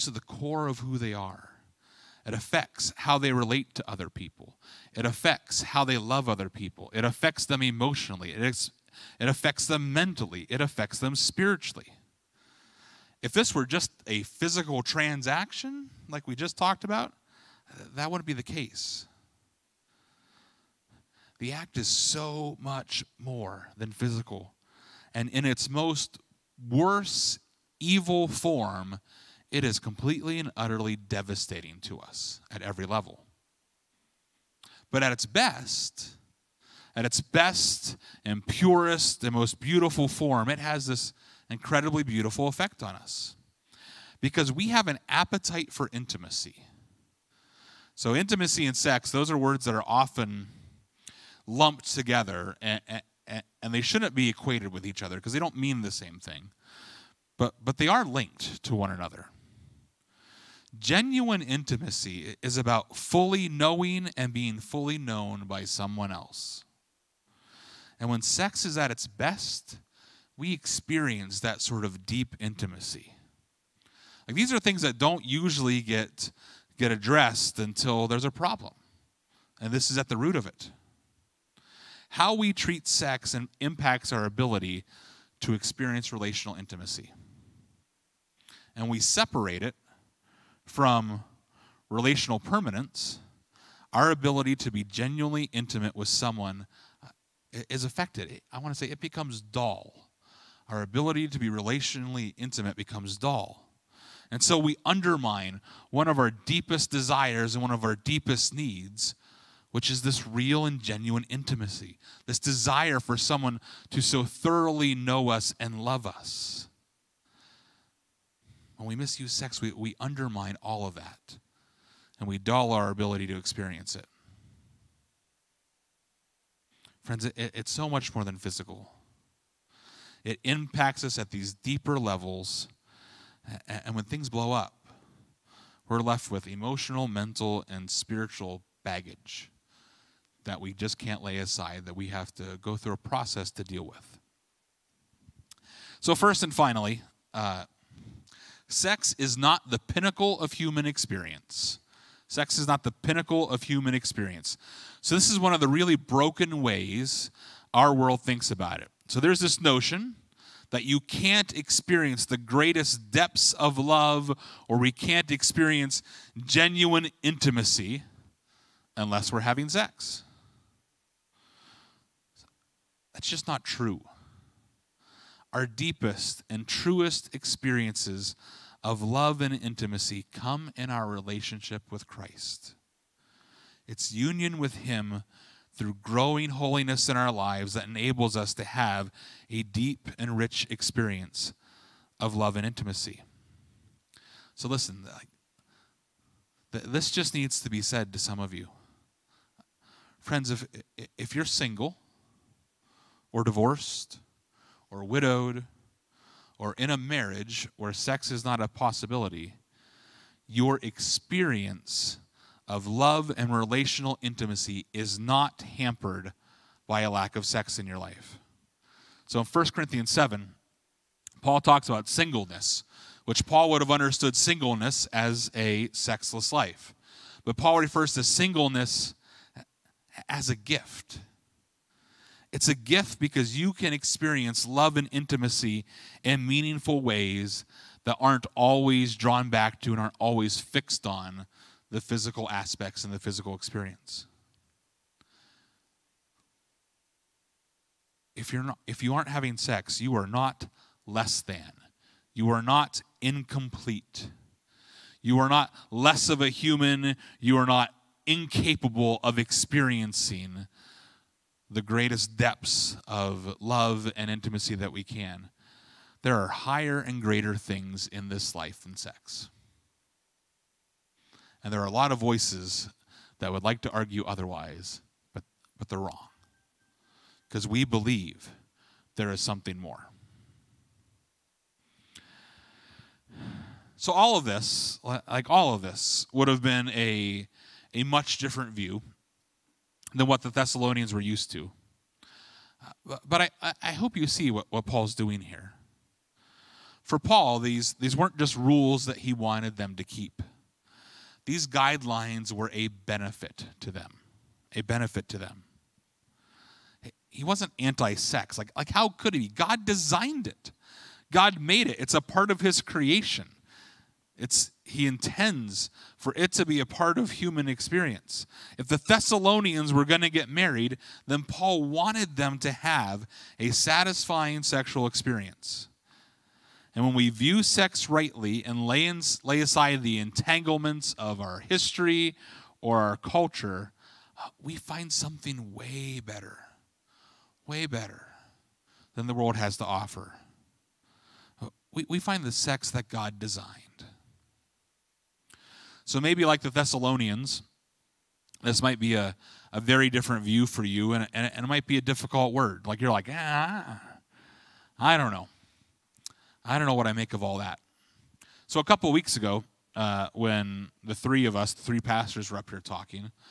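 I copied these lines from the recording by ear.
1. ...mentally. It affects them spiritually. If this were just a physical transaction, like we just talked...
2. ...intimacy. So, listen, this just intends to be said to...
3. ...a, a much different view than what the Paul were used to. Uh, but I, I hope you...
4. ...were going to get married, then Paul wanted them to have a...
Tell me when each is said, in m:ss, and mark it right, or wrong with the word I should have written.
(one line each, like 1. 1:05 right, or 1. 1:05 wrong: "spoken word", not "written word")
1. 0:09 right
2. 3:12 wrong: "needs", not "intends"
3. 4:46 wrong: "Thessalonians", not "Paul"
4. 5:19 right.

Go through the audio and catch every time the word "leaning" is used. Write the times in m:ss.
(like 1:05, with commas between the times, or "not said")
not said.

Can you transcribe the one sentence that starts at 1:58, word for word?
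When we misuse sex, we, we undermine all of that and we dull our ability to experience it.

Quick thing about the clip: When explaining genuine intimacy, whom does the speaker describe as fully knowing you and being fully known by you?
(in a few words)
someone else.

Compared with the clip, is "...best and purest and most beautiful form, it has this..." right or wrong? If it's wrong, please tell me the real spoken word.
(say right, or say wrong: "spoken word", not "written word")
right.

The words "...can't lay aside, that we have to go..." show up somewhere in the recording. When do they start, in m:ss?
2:20.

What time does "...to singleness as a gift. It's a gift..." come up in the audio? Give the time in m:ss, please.
3:48.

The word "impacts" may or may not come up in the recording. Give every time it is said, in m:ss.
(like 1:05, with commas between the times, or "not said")
1:23, 2:10.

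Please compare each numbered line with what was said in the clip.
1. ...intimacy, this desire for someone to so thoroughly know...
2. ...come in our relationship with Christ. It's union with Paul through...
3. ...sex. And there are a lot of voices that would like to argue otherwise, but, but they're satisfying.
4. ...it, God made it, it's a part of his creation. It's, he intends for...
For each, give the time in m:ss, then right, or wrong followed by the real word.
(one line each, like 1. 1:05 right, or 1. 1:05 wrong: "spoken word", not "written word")
1. 1:51 right
2. 3:00 wrong: "Him", not "Paul"
3. 4:28 wrong: "wrong", not "satisfying"
4. 5:10 right.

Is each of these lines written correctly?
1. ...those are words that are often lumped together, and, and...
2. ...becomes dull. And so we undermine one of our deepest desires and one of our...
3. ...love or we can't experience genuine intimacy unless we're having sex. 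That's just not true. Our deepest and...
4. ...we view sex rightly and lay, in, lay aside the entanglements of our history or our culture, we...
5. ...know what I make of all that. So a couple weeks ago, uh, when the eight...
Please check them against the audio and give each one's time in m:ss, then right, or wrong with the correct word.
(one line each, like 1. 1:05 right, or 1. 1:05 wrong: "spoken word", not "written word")
1. 0:49 right
2. 1:42 right
3. 2:43 right
4. 5:27 right
5. 5:56 wrong: "three", not "eight".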